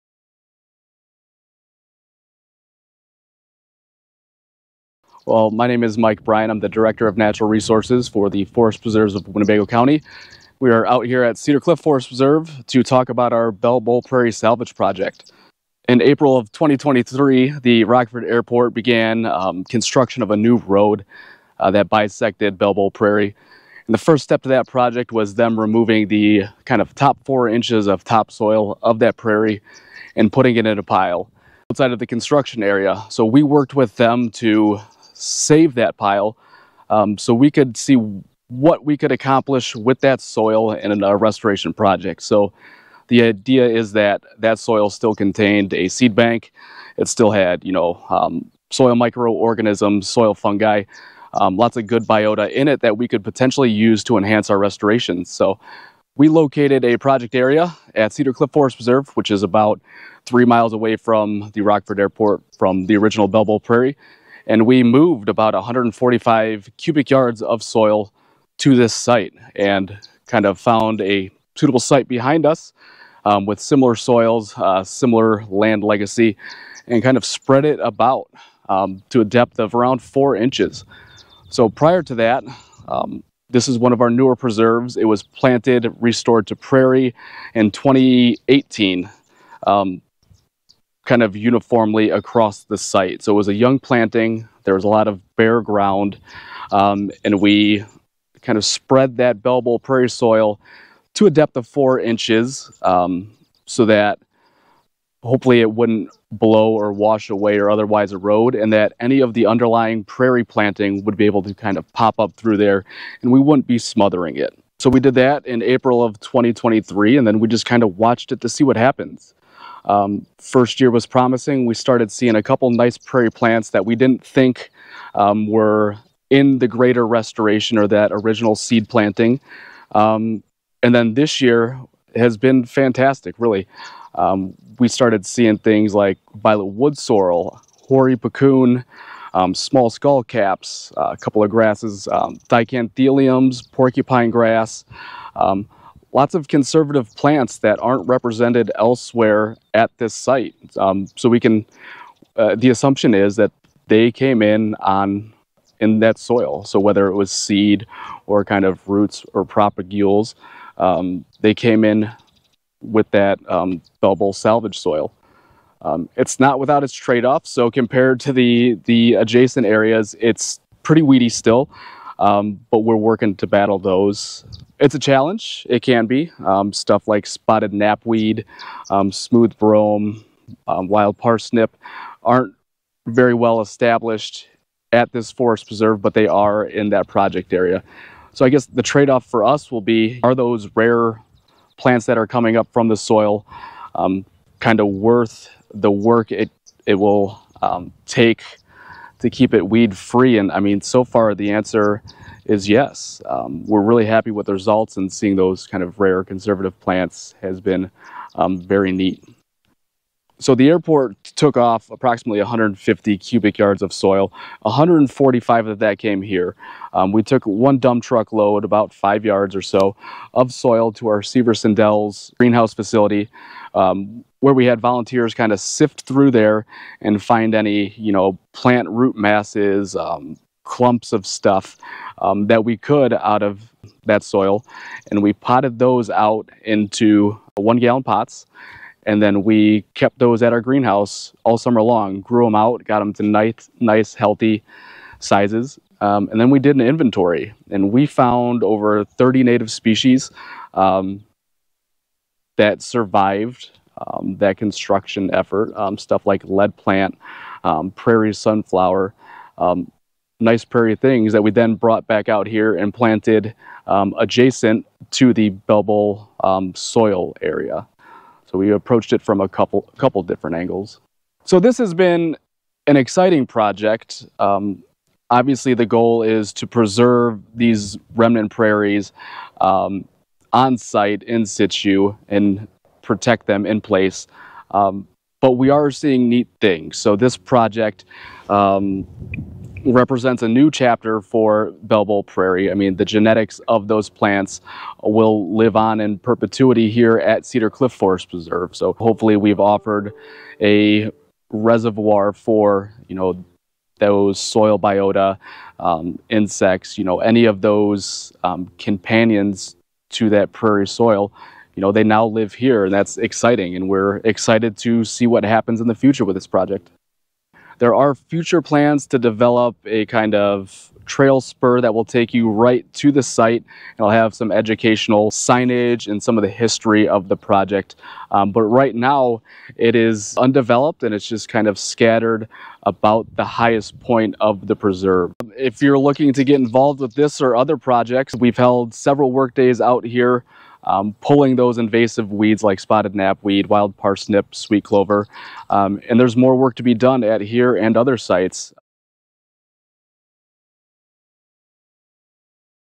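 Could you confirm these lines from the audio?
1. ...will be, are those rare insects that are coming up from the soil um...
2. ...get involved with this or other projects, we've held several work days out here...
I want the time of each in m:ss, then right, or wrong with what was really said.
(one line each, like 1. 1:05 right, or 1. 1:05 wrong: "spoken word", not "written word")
1. 3:09 wrong: "plants", not "insects"
2. 5:36 right.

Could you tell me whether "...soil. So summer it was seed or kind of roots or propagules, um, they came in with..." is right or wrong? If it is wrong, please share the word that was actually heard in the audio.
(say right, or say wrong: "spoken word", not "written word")
wrong: "whether", not "summer".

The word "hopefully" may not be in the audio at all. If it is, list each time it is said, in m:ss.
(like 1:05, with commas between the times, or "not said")
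1:45, 4:58.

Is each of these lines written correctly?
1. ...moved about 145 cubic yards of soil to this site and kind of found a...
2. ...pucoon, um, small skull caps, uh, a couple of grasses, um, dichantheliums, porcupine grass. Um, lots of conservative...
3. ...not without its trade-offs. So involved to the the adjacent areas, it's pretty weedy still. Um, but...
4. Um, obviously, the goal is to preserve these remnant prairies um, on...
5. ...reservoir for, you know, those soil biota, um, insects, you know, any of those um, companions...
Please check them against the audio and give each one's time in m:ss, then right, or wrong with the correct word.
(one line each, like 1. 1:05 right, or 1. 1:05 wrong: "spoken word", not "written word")
1. 1:04 right
2. 2:18 right
3. 2:46 wrong: "compared", not "involved"
4. 4:34 right
5. 5:01 right.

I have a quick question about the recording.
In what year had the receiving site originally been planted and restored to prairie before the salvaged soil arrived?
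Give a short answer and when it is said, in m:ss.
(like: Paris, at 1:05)
2018, at 1:27.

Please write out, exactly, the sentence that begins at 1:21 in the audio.
So prior to that, um, this is one of our newer preserves.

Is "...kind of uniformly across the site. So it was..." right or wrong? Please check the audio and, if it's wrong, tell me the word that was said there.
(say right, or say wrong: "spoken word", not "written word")
right.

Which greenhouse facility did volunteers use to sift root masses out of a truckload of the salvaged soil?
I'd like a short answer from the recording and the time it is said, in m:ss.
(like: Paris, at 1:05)
Severson Dells, at 3:41.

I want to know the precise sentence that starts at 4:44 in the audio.
Um, but we are seeing neat things.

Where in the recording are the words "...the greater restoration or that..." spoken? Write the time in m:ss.
2:06.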